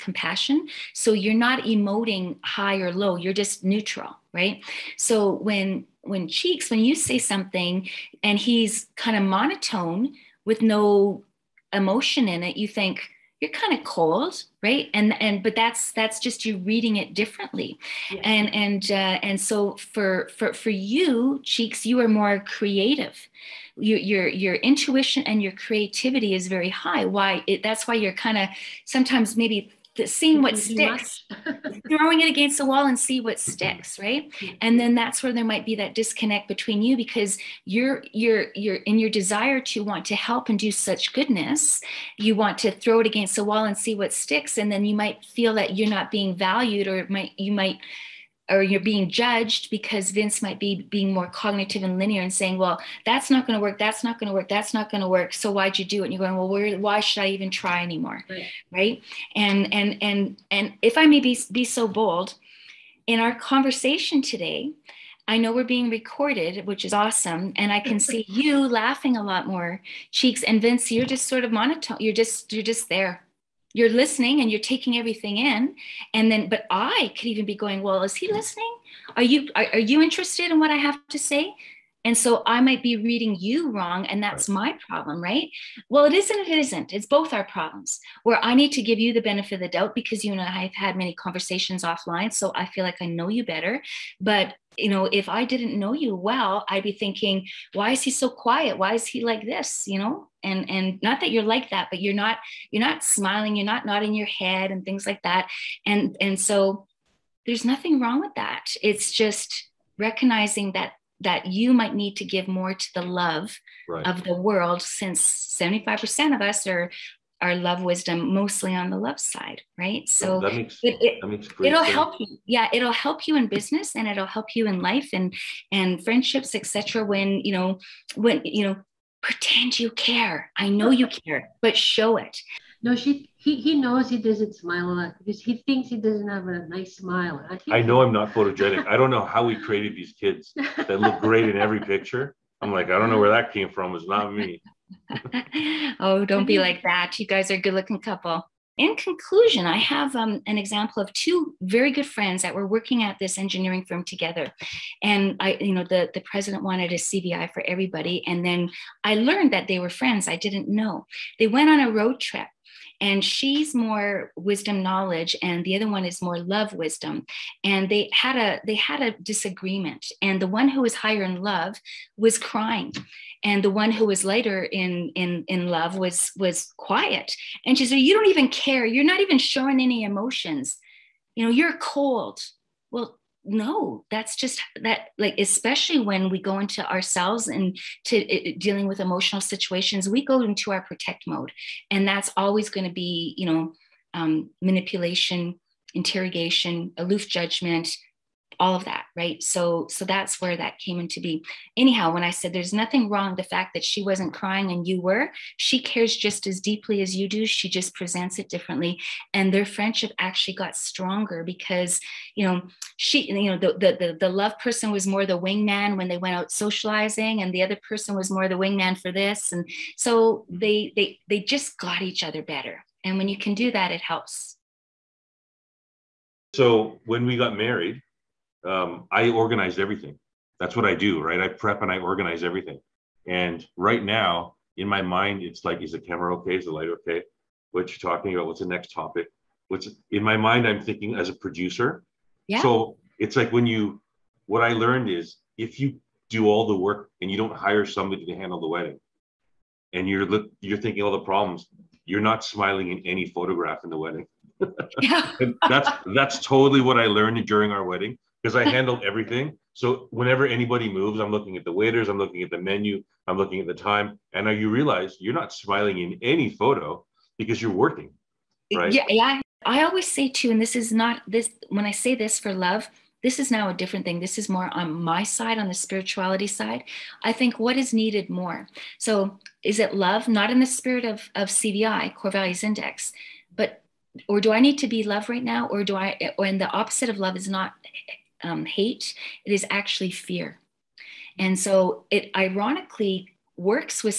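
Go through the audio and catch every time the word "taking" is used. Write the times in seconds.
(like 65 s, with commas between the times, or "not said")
74 s.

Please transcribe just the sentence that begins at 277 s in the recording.
I think what is needed more.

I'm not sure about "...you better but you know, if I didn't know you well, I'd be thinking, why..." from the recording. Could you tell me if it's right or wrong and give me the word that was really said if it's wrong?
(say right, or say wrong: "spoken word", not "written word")
right.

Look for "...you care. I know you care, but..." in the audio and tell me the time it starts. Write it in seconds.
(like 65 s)
129 s.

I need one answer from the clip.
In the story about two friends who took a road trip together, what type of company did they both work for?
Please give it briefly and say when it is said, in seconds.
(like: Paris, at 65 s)
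engineering firm, at 153 s.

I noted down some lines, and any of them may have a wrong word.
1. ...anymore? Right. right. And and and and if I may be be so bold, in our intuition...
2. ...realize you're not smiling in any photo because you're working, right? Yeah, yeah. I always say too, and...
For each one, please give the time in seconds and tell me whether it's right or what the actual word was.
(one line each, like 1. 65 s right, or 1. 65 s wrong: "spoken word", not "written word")
1. 57 s wrong: "conversation", not "intuition"
2. 264 s right.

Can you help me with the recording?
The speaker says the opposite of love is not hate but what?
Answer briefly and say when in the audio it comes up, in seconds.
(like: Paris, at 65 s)
fear, at 290 s.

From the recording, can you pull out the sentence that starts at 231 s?
I prep and I organize everything.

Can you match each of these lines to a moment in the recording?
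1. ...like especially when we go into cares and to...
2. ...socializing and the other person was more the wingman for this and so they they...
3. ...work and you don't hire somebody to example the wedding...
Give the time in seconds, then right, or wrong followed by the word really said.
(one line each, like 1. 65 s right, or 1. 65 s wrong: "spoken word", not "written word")
1. 185 s wrong: "ourselves", not "cares"
2. 216 s right
3. 246 s wrong: "handle", not "example".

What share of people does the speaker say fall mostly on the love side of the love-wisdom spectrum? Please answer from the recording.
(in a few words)
75%.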